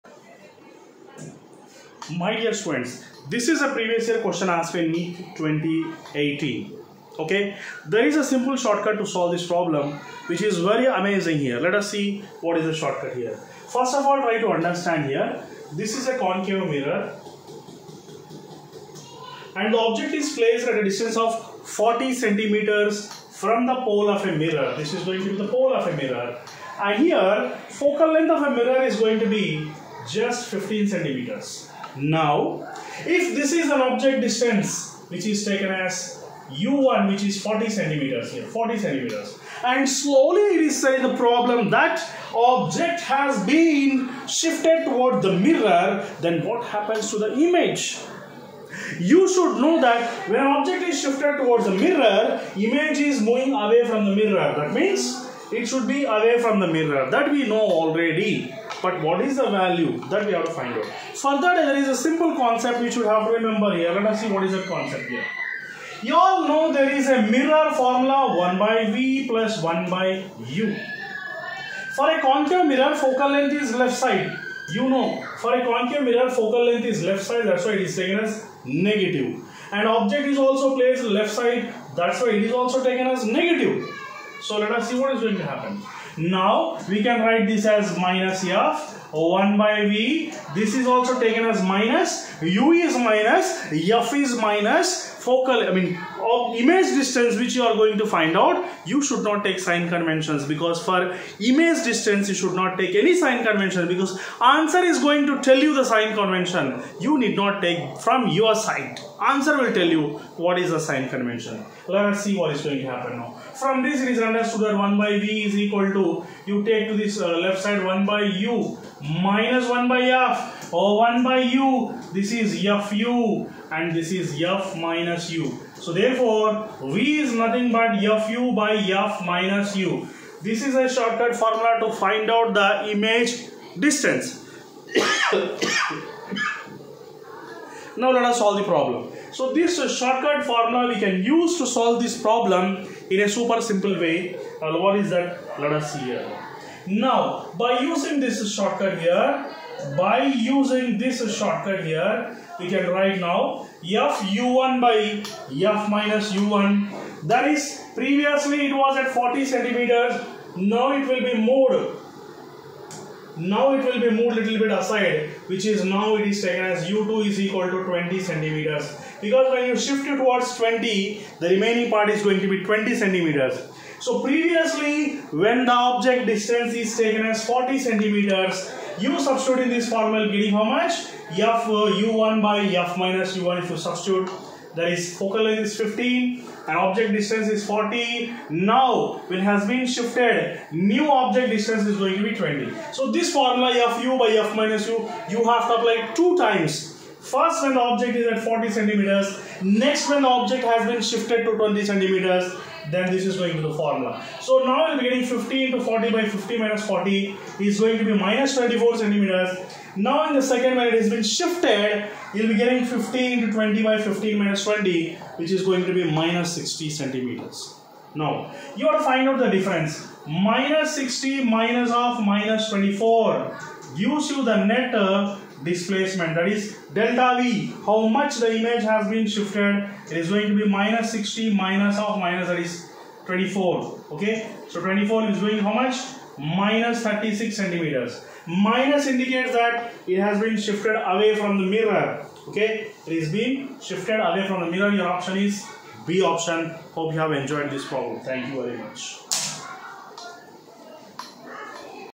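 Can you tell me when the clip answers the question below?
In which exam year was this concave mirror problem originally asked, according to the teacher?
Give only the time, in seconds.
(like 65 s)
5 s.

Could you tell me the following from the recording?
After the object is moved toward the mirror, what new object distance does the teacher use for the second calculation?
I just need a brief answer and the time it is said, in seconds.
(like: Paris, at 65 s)
20 centimeters, at 166 s.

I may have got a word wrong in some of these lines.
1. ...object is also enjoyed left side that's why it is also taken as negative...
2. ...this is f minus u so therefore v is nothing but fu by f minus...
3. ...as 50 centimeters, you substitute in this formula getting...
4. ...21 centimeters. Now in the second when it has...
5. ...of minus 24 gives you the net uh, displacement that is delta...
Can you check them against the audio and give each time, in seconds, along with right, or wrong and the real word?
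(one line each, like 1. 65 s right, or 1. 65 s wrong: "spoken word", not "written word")
1. 79 s wrong: "placed", not "enjoyed"
2. 123 s right
3. 177 s wrong: "40", not "50"
4. 208 s wrong: "24", not "21"
5. 221 s right.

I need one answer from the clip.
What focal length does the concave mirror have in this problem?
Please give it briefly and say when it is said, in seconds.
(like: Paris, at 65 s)
15 centimeters, at 30 s.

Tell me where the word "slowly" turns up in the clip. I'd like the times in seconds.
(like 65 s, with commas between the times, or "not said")
39 s.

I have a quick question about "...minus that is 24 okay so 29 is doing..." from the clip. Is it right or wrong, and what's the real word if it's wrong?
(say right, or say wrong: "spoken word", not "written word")
wrong: "24", not "29".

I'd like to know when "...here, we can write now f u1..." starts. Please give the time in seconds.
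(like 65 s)
151 s.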